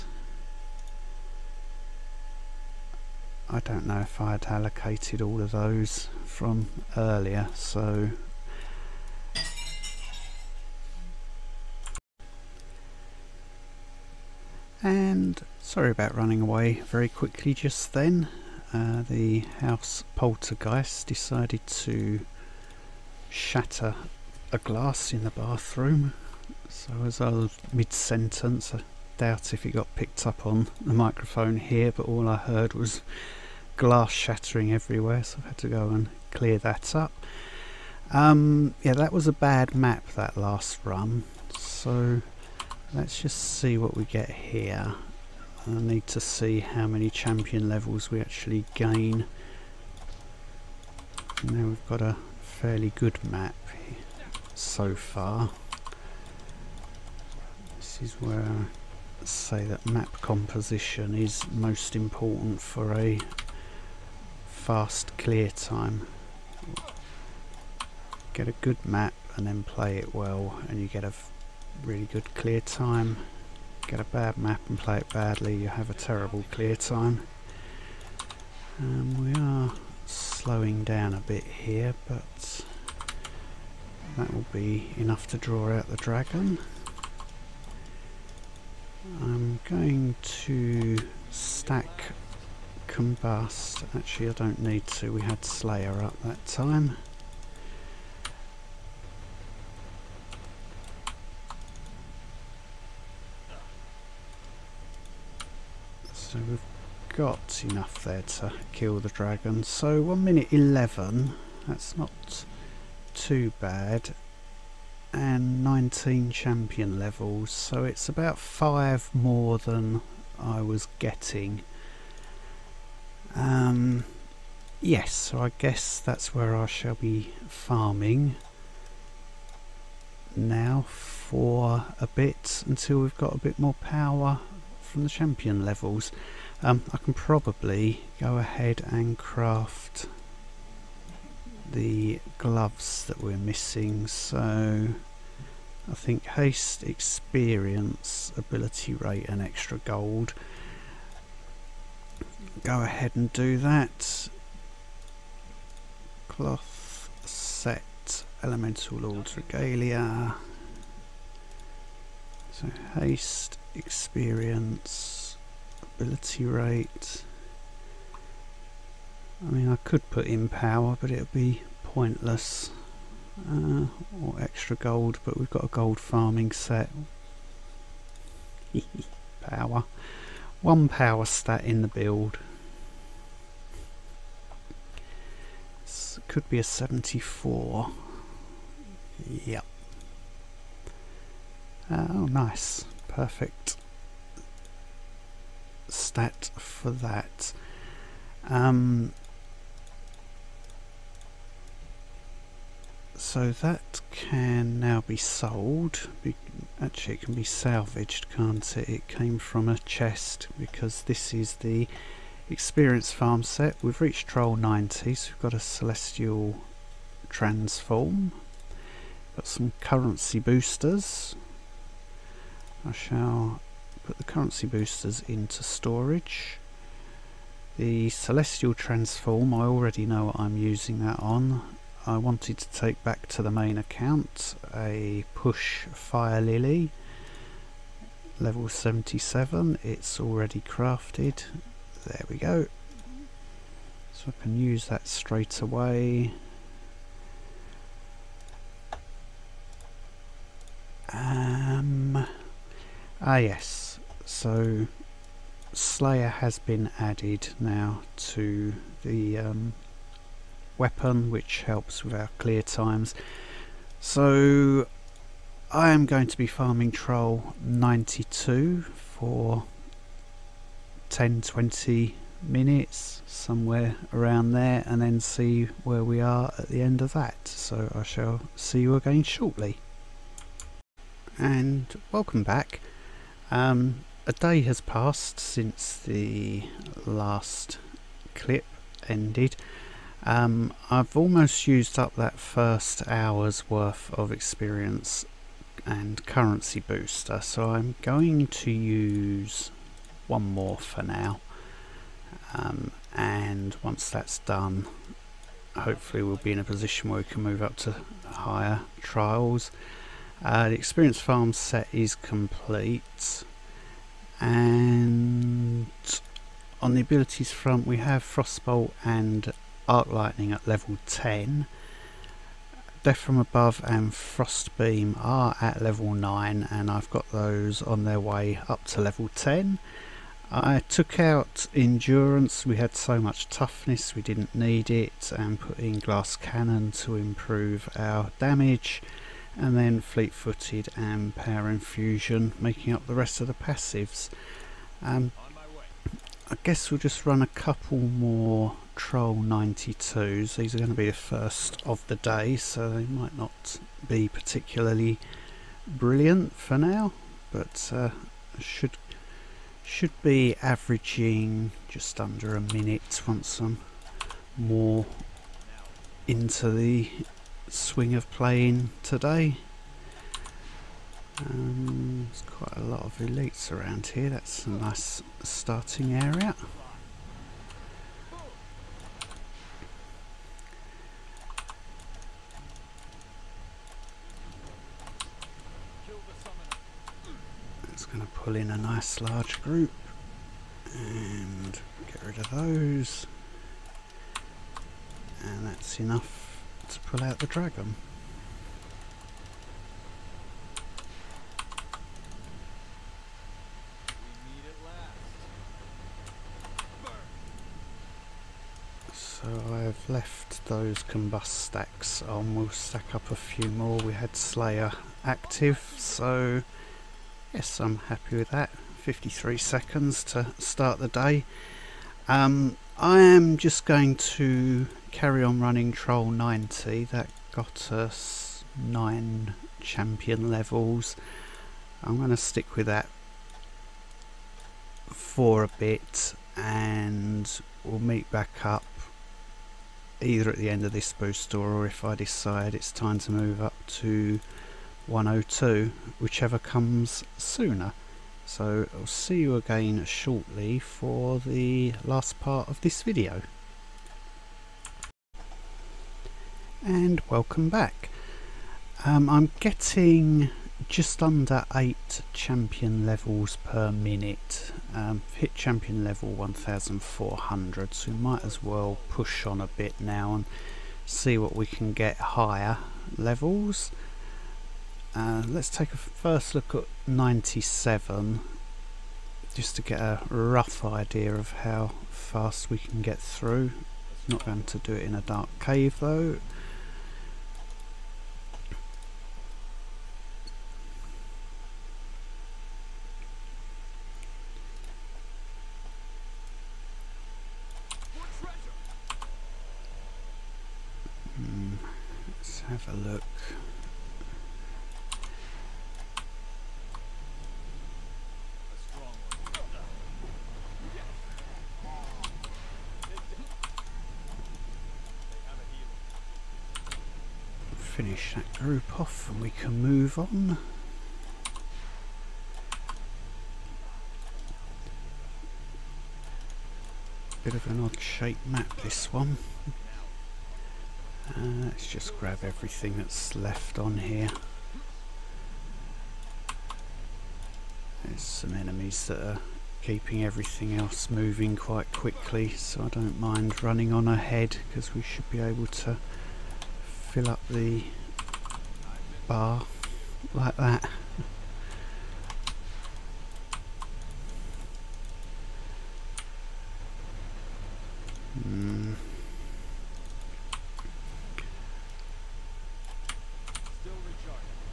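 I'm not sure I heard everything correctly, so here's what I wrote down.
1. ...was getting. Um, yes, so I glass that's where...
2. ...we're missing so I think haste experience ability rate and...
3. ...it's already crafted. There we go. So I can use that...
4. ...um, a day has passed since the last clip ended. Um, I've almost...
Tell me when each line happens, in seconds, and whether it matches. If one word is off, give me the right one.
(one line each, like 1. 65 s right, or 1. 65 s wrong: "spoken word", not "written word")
1. 120 s wrong: "guess", not "glass"
2. 143 s right
3. 239 s right
4. 283 s right.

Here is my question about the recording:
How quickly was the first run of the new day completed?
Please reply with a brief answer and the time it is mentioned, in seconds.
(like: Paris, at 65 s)
53 seconds, at 418 s.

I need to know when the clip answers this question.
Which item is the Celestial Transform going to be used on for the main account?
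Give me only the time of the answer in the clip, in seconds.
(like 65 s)
235 s.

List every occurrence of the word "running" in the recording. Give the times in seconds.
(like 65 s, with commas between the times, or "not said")
16 s, 425 s, 543 s.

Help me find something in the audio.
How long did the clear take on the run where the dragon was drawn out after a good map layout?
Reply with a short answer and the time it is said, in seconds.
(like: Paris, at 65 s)
1 minute 11, at 110 s.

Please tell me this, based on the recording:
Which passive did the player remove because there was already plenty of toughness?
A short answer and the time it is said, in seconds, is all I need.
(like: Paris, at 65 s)
Endurance, at 331 s.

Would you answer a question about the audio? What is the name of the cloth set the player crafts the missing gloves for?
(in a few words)
Elemental Lords Regalia.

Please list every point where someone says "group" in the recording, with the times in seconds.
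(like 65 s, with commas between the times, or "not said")
389 s, 518 s.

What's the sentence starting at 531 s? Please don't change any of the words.
Uh, let's just grab everything that's left on here.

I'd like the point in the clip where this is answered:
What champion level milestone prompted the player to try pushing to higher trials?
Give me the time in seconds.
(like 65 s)
466 s.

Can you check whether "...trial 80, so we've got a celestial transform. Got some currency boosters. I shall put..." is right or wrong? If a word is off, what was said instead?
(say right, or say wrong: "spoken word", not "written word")
wrong: "90", not "80".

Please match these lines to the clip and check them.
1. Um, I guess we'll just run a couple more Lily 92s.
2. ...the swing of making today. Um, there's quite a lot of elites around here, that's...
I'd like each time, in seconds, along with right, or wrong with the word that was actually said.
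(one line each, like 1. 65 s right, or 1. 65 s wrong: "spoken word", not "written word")
1. 345 s wrong: "Trial", not "Lily"
2. 366 s wrong: "playing", not "making".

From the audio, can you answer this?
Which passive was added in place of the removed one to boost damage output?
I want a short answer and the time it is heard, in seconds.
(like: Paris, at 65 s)
Glass Cannon, at 335 s.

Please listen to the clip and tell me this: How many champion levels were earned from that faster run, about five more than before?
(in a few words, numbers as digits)
19.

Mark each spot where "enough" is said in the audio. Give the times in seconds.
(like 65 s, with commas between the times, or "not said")
84 s, 107 s, 395 s.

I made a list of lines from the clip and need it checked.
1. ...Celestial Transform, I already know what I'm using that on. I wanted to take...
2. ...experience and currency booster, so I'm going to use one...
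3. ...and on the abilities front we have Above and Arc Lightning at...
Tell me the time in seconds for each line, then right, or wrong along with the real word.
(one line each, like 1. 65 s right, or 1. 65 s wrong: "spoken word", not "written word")
1. 228 s right
2. 294 s right
3. 314 s wrong: "Frostbolt", not "Above".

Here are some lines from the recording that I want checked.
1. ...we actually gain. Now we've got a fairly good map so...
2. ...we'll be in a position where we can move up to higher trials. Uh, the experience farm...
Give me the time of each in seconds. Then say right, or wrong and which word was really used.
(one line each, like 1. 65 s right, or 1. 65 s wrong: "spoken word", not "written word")
1. 48 s right
2. 306 s right.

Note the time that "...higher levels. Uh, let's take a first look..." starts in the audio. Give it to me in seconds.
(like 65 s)
472 s.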